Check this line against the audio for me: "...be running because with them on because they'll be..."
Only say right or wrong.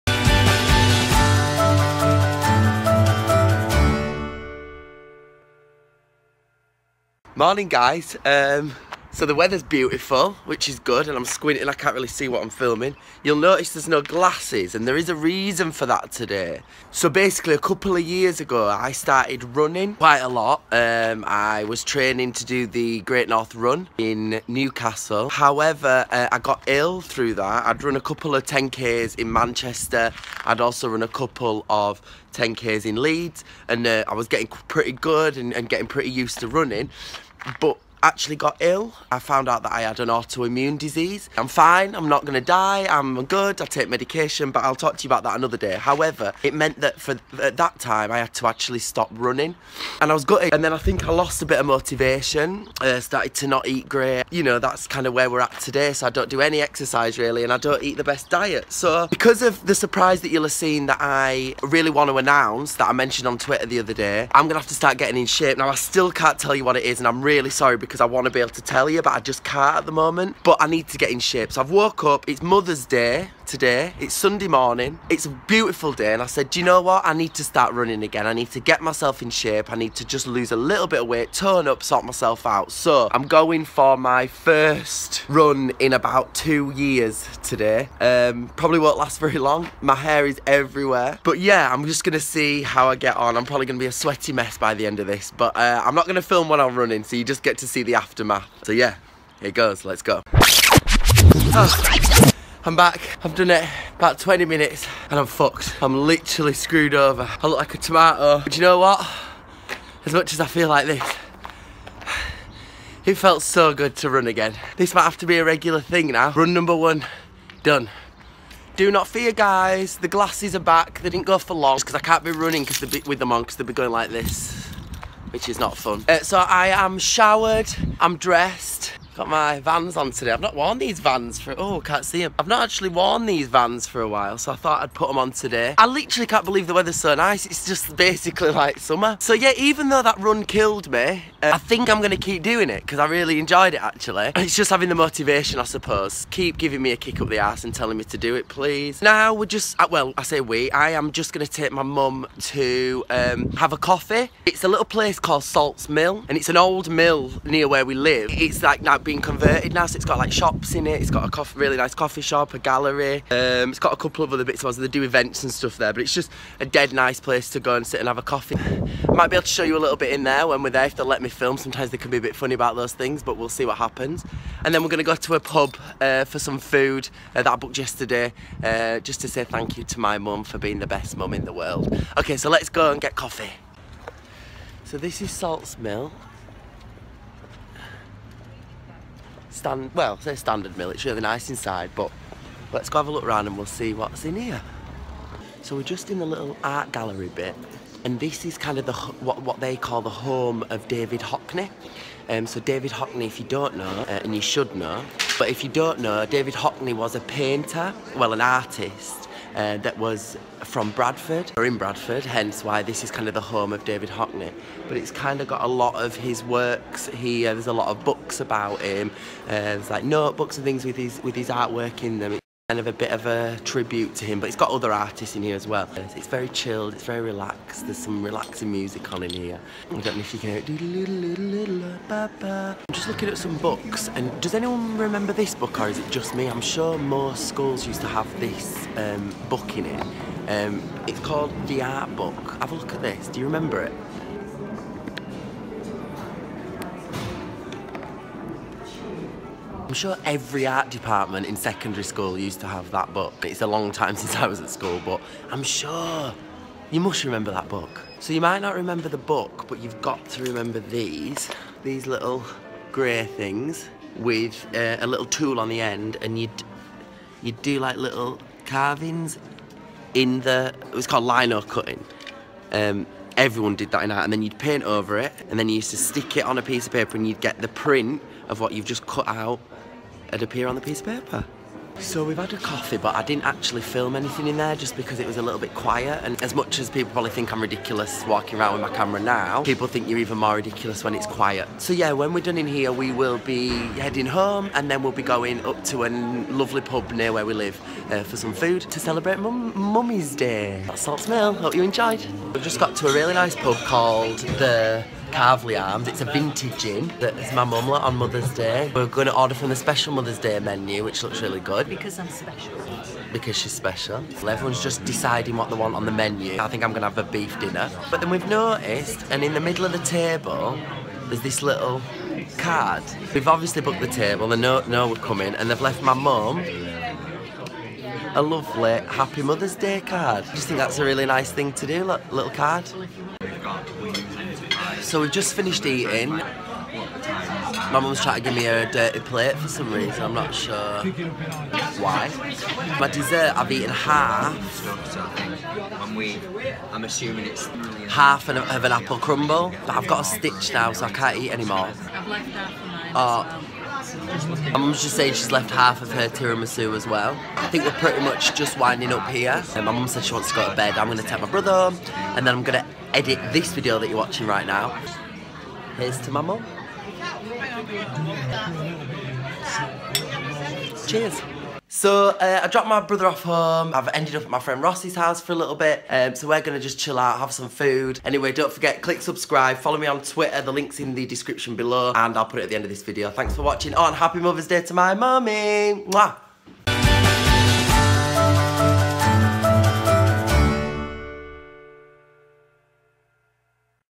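right.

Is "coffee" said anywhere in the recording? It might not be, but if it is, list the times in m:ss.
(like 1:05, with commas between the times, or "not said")
2:33, 2:41, 2:48, 3:03, 4:42.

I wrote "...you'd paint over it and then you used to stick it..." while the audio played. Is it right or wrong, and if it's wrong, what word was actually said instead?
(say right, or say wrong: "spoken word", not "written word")
right.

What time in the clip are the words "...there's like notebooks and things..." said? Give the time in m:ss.
3:39.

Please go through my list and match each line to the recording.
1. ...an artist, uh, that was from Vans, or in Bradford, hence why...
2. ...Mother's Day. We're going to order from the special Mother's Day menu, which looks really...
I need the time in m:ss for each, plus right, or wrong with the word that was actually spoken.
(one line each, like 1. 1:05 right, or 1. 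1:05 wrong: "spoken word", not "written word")
1. 3:28 wrong: "Bradford", not "Vans"
2. 5:08 right.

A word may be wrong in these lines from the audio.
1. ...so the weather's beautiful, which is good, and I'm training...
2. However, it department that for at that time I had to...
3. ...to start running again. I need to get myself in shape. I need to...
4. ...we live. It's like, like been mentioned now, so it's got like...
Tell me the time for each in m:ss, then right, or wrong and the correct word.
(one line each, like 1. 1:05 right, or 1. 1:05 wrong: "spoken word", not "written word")
1. 0:09 wrong: "squinting", not "training"
2. 0:45 wrong: "meant", not "department"
3. 1:17 right
4. 2:37 wrong: "converted", not "mentioned".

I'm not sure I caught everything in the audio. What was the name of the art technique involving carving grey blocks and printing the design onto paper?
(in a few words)
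lino cutting.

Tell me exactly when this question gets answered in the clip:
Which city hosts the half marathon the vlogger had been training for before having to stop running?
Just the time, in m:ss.
0:24.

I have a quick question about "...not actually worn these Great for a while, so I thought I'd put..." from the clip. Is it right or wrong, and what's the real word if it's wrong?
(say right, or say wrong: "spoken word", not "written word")
wrong: "Vans", not "Great".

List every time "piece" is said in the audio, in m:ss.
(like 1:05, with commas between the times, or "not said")
4:36, 4:40.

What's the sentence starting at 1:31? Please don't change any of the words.
But yeah, I'm just going to see how I get on.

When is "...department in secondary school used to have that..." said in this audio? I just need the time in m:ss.
4:10.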